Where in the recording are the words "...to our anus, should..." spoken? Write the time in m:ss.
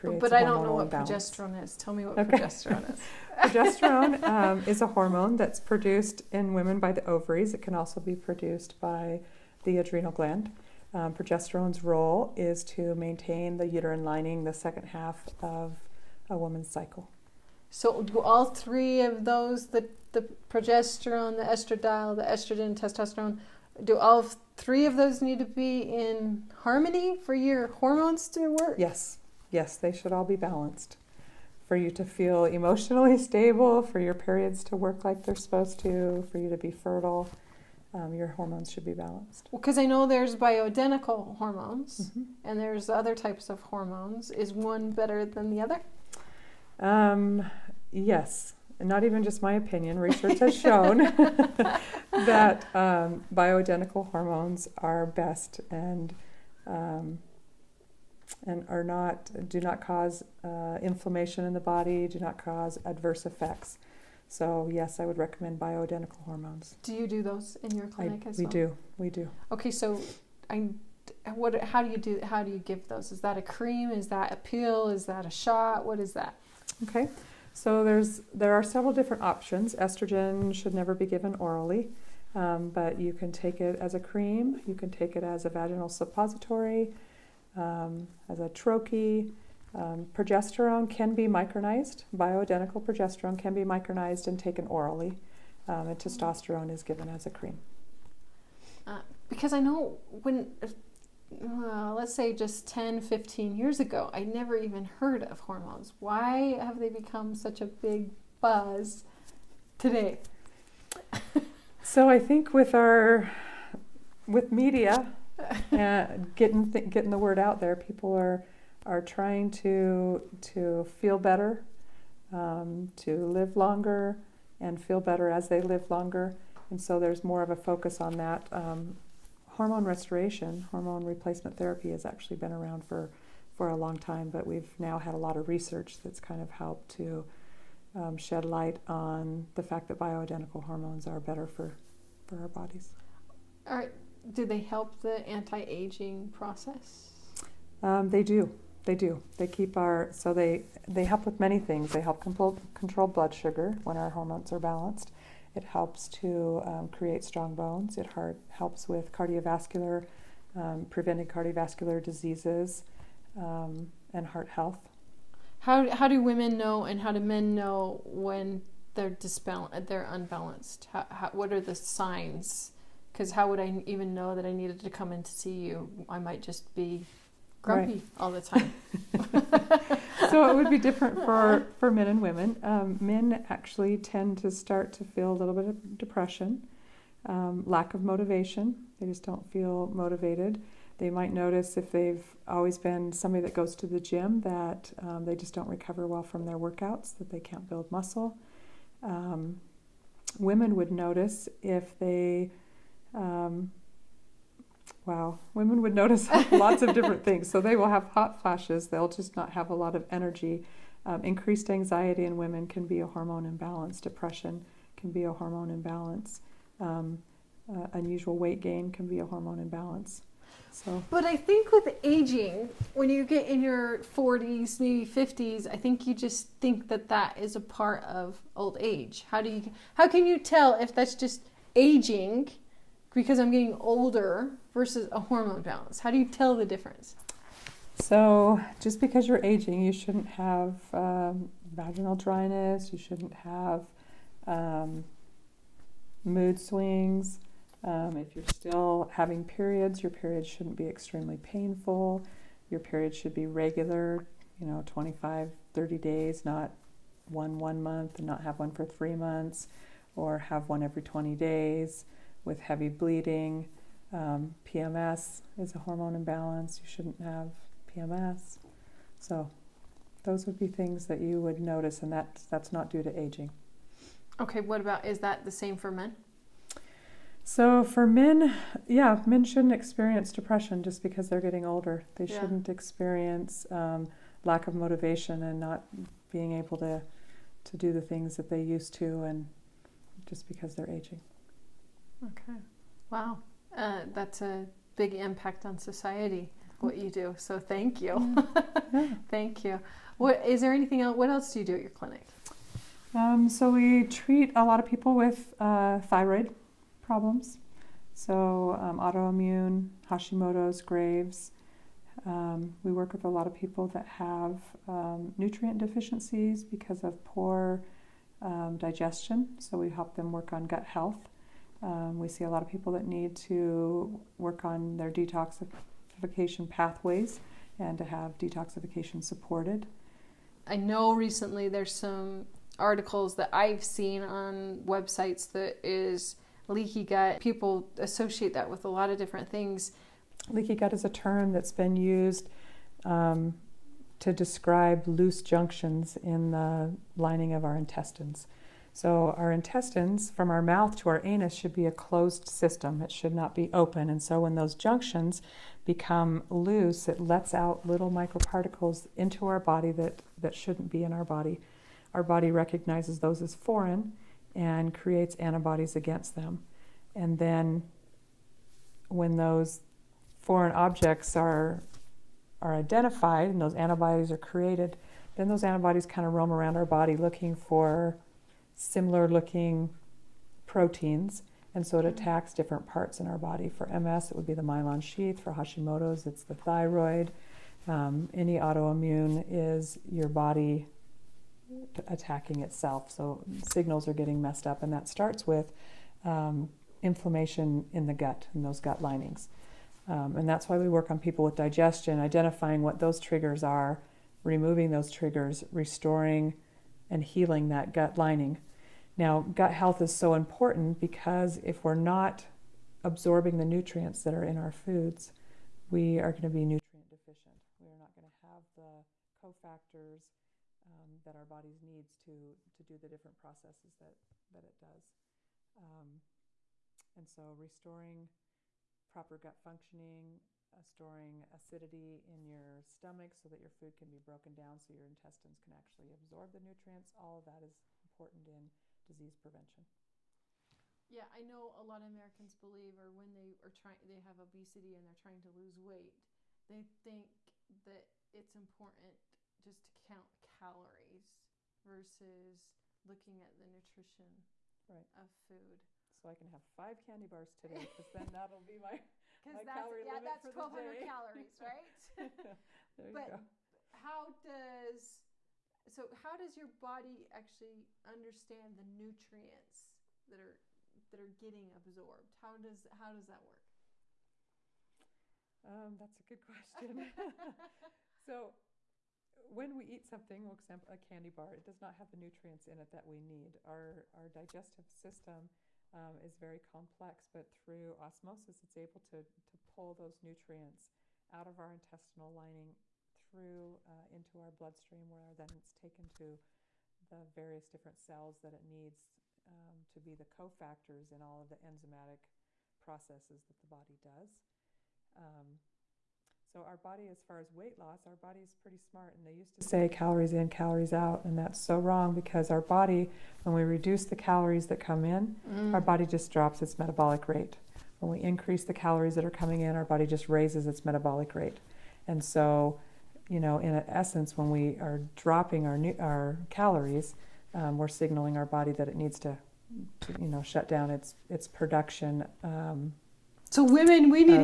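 5:50.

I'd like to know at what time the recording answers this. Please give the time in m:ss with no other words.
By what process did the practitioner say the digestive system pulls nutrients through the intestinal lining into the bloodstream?
8:07.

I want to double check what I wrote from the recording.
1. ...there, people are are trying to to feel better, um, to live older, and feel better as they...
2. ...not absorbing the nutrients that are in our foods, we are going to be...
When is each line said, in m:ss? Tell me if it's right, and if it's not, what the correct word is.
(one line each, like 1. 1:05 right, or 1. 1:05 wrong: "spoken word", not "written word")
1. 1:57 wrong: "longer", not "older"
2. 6:51 right.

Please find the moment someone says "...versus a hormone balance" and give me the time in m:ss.
3:54.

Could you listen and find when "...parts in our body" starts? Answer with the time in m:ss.
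6:22.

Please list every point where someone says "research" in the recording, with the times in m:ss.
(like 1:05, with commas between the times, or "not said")
0:49, 2:15.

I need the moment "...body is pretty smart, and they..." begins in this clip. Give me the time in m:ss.
8:28.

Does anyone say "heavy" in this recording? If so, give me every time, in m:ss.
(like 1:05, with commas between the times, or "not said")
4:22.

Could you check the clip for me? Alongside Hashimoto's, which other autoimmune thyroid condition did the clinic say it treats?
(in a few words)
Graves.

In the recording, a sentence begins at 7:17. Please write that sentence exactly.
All of that is important in disease prevention.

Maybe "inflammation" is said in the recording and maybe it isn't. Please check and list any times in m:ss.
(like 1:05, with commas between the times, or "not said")
1:00, 6:37.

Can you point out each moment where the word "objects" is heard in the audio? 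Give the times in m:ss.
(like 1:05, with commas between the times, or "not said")
6:10.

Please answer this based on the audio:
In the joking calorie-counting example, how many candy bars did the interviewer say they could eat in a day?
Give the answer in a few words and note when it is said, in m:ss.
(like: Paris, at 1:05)
5, at 7:36.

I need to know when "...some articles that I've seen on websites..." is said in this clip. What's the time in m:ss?
5:31.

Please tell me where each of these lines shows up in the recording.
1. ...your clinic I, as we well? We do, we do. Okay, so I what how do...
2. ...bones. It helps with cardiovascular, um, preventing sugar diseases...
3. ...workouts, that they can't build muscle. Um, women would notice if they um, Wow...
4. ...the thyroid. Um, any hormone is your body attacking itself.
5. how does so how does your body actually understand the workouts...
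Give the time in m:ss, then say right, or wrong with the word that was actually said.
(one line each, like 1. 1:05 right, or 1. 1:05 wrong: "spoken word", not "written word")
1. 1:07 right
2. 2:37 wrong: "cardiovascular", not "sugar"
3. 3:16 right
4. 6:26 wrong: "autoimmune", not "hormone"
5. 7:43 wrong: "nutrients", not "workouts".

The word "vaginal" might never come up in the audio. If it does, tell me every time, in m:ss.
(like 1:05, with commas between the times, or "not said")
1:25, 4:01.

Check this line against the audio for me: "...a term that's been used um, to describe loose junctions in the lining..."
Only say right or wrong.
right.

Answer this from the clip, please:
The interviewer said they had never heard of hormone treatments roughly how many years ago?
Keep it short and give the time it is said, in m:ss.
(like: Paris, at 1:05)
10, 15 years, at 1:42.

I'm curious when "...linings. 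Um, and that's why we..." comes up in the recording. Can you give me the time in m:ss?
6:39.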